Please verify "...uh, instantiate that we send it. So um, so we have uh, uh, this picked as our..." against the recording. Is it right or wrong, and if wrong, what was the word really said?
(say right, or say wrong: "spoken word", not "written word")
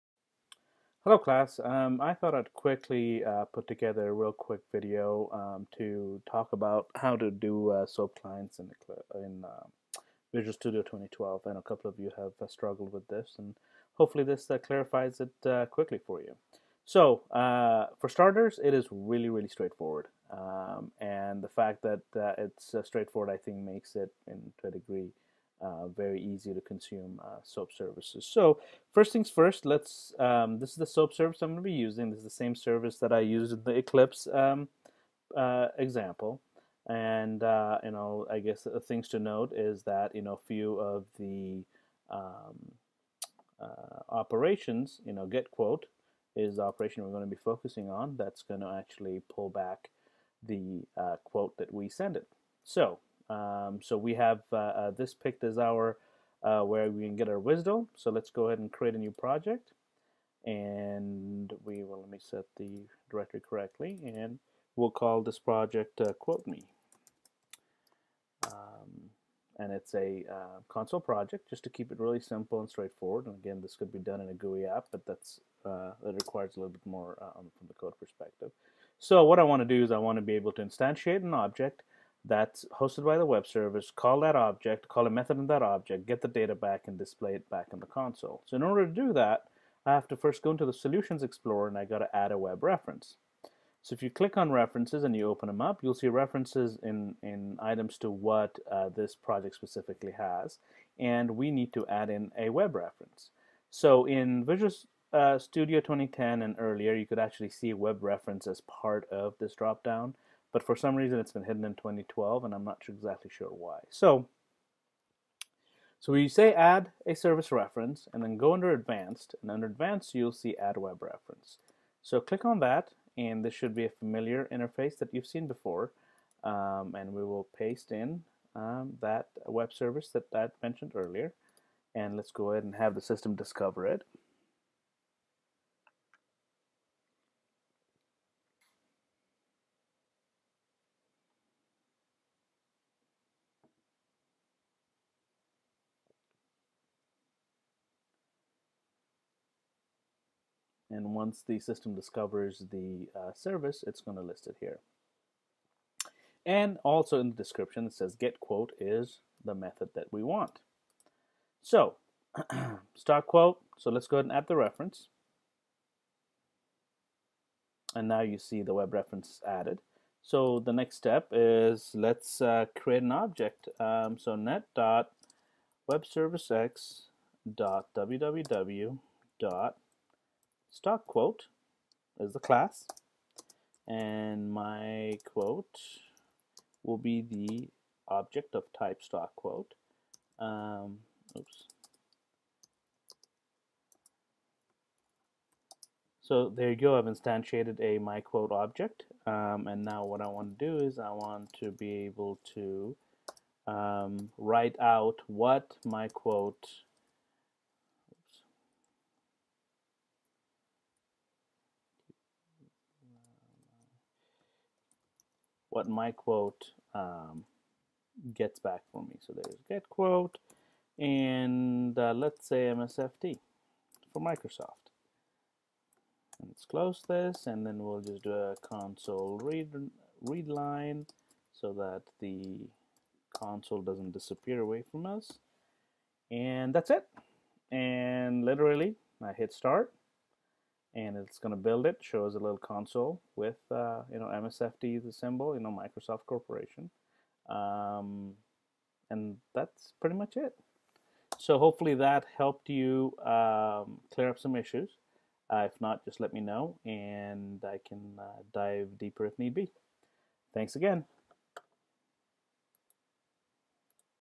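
wrong: "quote", not "instantiate".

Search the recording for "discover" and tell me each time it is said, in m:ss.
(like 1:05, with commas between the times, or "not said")
2:13, 2:31.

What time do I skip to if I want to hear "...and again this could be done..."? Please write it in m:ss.
1:13.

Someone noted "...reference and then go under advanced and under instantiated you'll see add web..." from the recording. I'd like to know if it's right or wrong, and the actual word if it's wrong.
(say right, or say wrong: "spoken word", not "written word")
wrong: "advanced", not "instantiated".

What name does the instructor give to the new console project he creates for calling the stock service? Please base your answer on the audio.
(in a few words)
Quote Me.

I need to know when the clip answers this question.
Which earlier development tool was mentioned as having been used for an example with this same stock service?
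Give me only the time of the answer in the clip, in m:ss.
0:33.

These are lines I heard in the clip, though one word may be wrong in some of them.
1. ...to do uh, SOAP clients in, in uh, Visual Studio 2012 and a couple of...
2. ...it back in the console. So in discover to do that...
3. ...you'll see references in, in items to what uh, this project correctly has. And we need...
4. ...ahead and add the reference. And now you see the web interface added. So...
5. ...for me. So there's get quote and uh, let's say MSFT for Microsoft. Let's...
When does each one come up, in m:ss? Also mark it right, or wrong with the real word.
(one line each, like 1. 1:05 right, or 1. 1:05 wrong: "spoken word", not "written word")
1. 0:07 right
2. 1:27 wrong: "order", not "discover"
3. 1:35 wrong: "specifically", not "correctly"
4. 2:44 wrong: "reference", not "interface"
5. 3:38 right.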